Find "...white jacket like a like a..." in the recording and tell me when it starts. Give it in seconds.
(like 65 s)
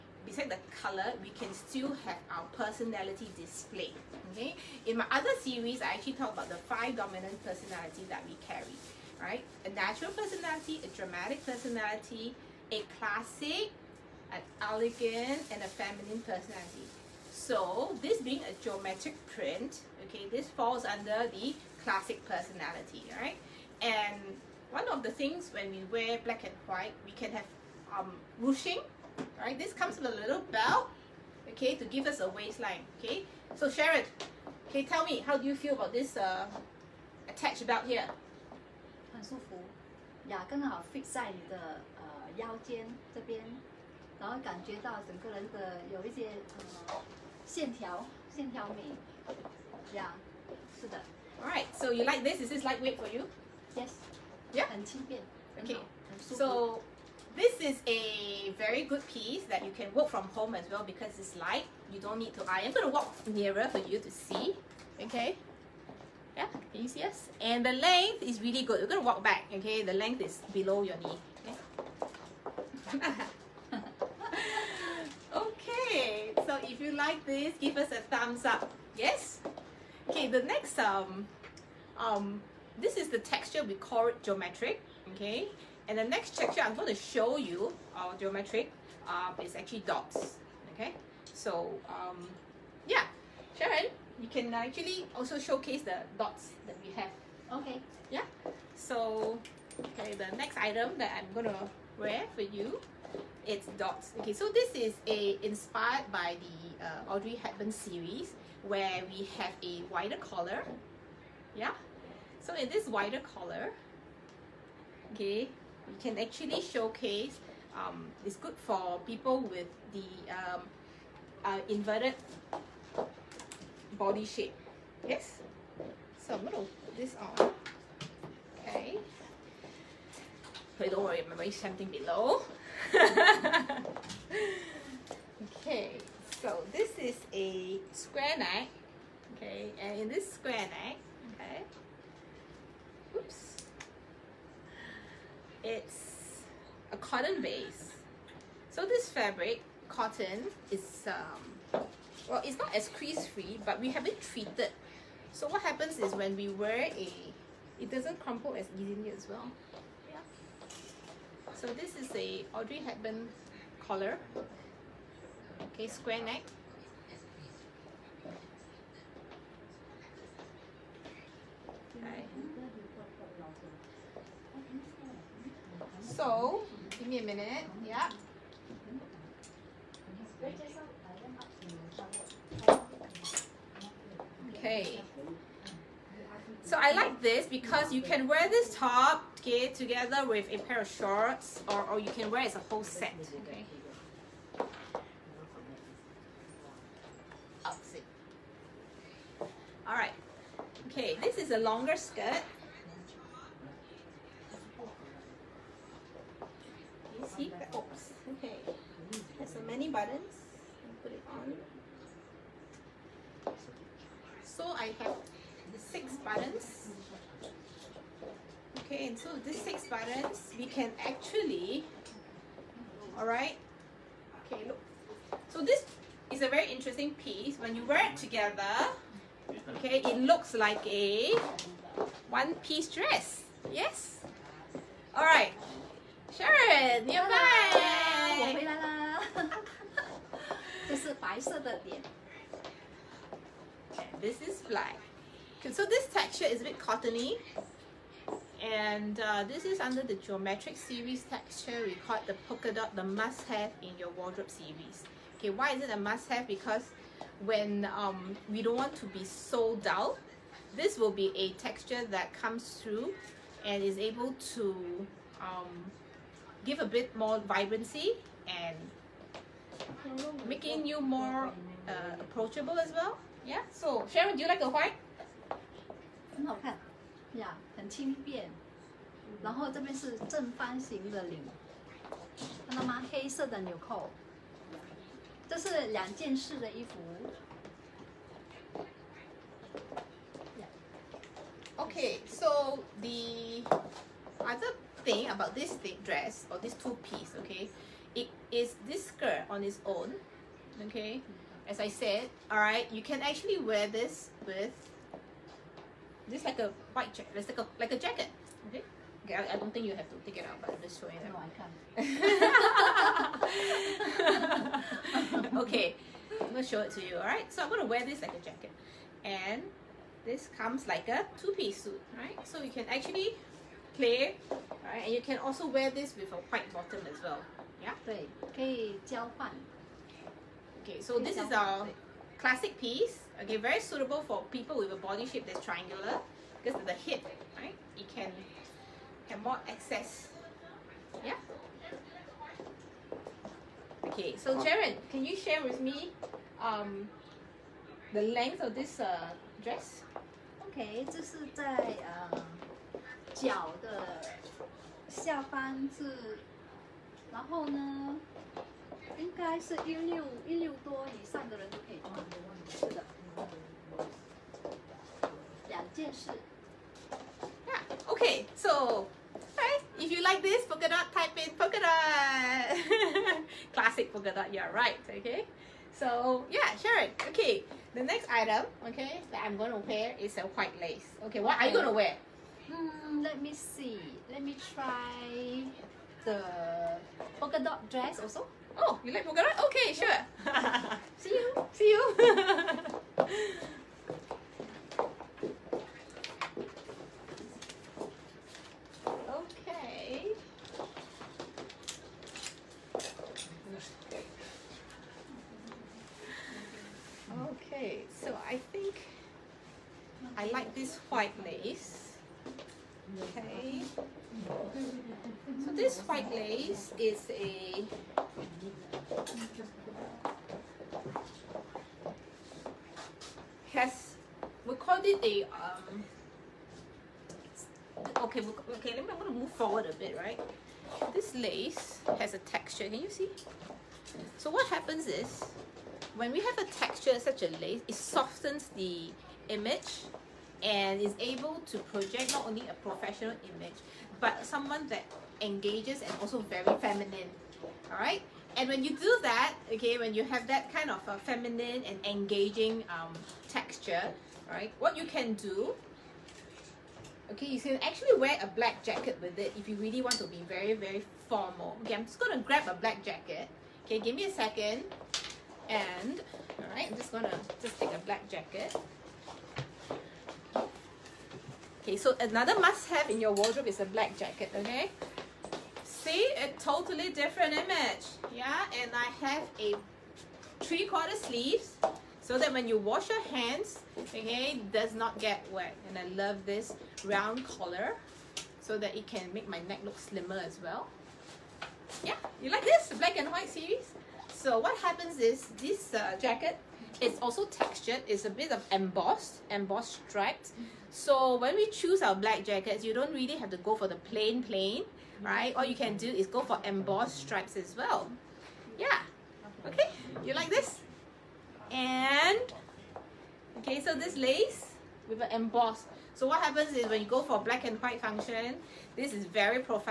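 306 s.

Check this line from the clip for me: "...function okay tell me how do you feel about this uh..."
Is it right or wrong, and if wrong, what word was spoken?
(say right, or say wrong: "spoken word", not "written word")
wrong: "sharon", not "function".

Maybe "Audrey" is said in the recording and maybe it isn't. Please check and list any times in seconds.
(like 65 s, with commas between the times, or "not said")
107 s, 162 s.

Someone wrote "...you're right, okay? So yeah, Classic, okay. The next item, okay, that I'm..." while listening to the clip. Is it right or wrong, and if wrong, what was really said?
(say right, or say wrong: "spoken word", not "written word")
wrong: "Sharon", not "Classic".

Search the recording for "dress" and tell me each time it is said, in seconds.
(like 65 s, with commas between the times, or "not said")
232 s, 296 s, 349 s, 387 s.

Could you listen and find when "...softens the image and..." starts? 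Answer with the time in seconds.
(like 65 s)
437 s.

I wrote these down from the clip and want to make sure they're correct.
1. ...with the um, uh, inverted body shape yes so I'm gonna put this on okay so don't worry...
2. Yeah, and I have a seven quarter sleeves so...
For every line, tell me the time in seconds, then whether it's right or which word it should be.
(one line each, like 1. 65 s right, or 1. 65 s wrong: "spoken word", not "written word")
1. 119 s right
2. 478 s wrong: "three", not "seven".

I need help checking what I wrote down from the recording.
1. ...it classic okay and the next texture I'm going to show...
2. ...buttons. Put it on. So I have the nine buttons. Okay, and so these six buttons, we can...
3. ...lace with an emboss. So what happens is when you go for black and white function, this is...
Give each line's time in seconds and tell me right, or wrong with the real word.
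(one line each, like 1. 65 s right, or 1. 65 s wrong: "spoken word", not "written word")
1. 84 s wrong: "geometric", not "classic"
2. 209 s wrong: "six", not "nine"
3. 514 s right.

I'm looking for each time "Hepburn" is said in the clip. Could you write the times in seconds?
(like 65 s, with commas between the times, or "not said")
107 s, 162 s.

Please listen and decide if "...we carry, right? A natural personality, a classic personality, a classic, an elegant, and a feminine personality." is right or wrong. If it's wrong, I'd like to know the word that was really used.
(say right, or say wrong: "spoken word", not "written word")
wrong: "dramatic", not "classic".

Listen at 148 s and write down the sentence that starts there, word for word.
So this fabric, cotton, is, um, well, it's not as crease-free, but we have it treated.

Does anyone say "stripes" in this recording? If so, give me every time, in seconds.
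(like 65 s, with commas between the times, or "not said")
500 s, 507 s.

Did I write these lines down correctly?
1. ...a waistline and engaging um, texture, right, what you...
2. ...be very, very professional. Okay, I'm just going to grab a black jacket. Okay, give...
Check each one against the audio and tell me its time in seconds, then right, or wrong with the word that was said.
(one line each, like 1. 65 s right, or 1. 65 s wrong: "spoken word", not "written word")
1. 451 s wrong: "feminine", not "waistline"
2. 460 s wrong: "formal", not "professional".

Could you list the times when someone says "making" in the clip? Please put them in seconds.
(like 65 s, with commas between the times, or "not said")
270 s.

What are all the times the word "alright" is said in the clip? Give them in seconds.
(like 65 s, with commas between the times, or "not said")
51 s, 199 s, 317 s.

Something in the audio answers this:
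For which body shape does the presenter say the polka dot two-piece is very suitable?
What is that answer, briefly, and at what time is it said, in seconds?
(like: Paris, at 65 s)
Triangular, at 335 s.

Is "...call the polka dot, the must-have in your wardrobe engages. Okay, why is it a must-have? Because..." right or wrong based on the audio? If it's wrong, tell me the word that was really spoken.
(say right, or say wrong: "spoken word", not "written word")
wrong: "series", not "engages".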